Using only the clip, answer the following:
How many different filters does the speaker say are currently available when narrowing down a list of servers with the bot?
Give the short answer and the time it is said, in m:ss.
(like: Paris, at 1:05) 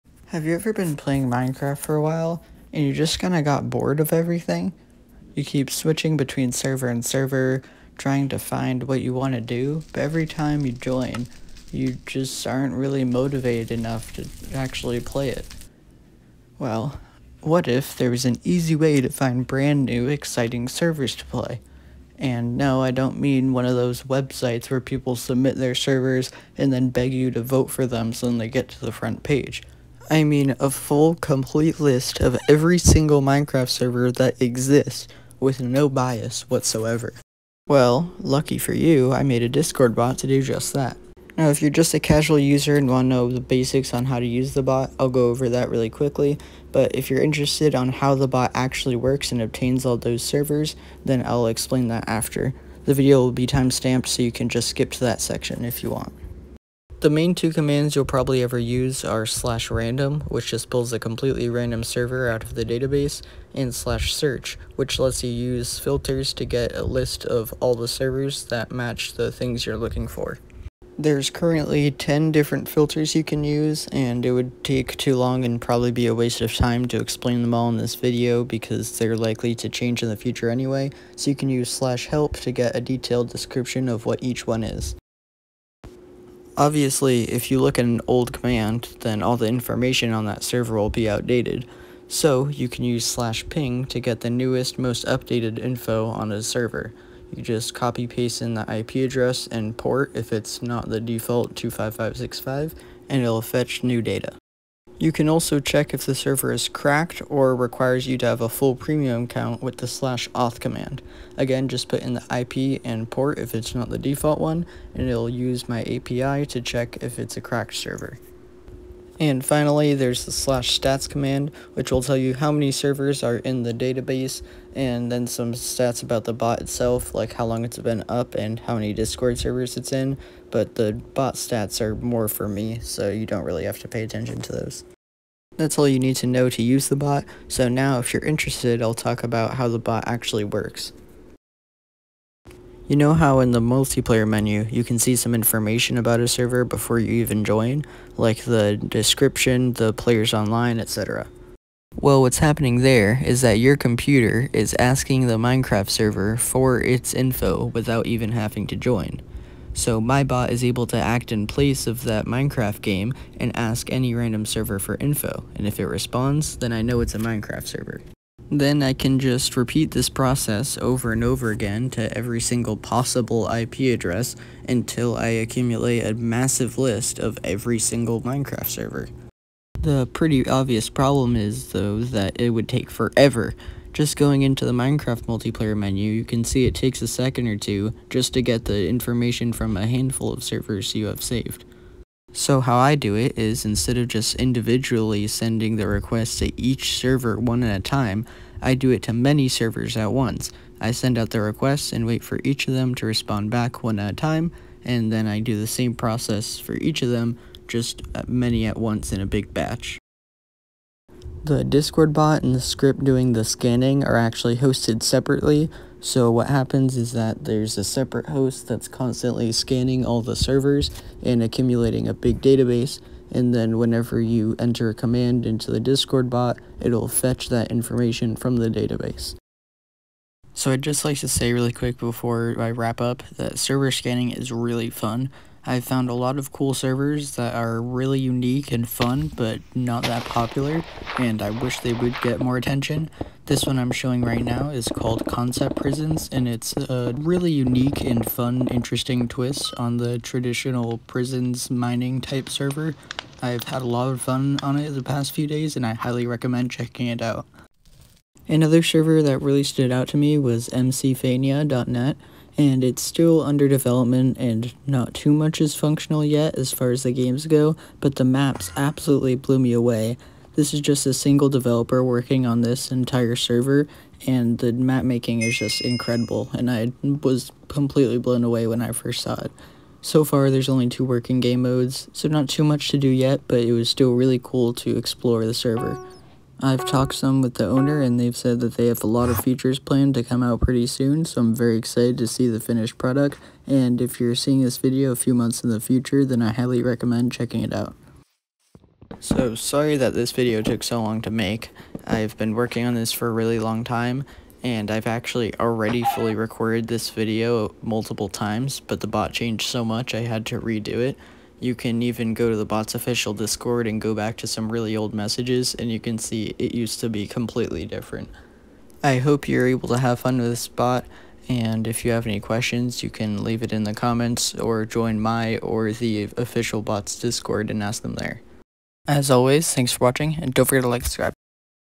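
10, at 1:11.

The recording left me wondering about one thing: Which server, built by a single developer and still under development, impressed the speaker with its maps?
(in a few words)
mcfania.net.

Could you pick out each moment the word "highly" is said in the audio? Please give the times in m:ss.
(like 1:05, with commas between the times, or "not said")
4:15, 4:56.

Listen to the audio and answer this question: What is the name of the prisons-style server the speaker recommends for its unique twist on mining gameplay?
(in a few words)
Concept Prisons.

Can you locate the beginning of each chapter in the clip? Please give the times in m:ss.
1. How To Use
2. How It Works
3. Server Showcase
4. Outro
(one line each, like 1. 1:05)
1. 0:57
2. 2:21
3. 3:50
4. 4:58.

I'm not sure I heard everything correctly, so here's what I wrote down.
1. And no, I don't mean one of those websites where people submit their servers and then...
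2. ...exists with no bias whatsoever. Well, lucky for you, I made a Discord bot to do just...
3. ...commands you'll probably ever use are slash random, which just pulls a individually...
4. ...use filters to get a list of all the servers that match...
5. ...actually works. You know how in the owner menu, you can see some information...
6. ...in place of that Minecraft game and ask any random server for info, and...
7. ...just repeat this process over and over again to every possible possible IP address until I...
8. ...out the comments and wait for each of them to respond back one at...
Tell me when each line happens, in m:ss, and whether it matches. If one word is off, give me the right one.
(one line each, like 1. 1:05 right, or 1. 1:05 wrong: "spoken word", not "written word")
1. 0:22 right
2. 0:34 right
3. 0:57 wrong: "completely", not "individually"
4. 1:05 right
5. 2:20 wrong: "multiplayer", not "owner"
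6. 2:41 right
7. 2:49 wrong: "single", not "possible"
8. 3:21 wrong: "requests", not "comments".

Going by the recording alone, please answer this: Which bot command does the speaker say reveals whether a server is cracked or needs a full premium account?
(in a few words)
slash auth.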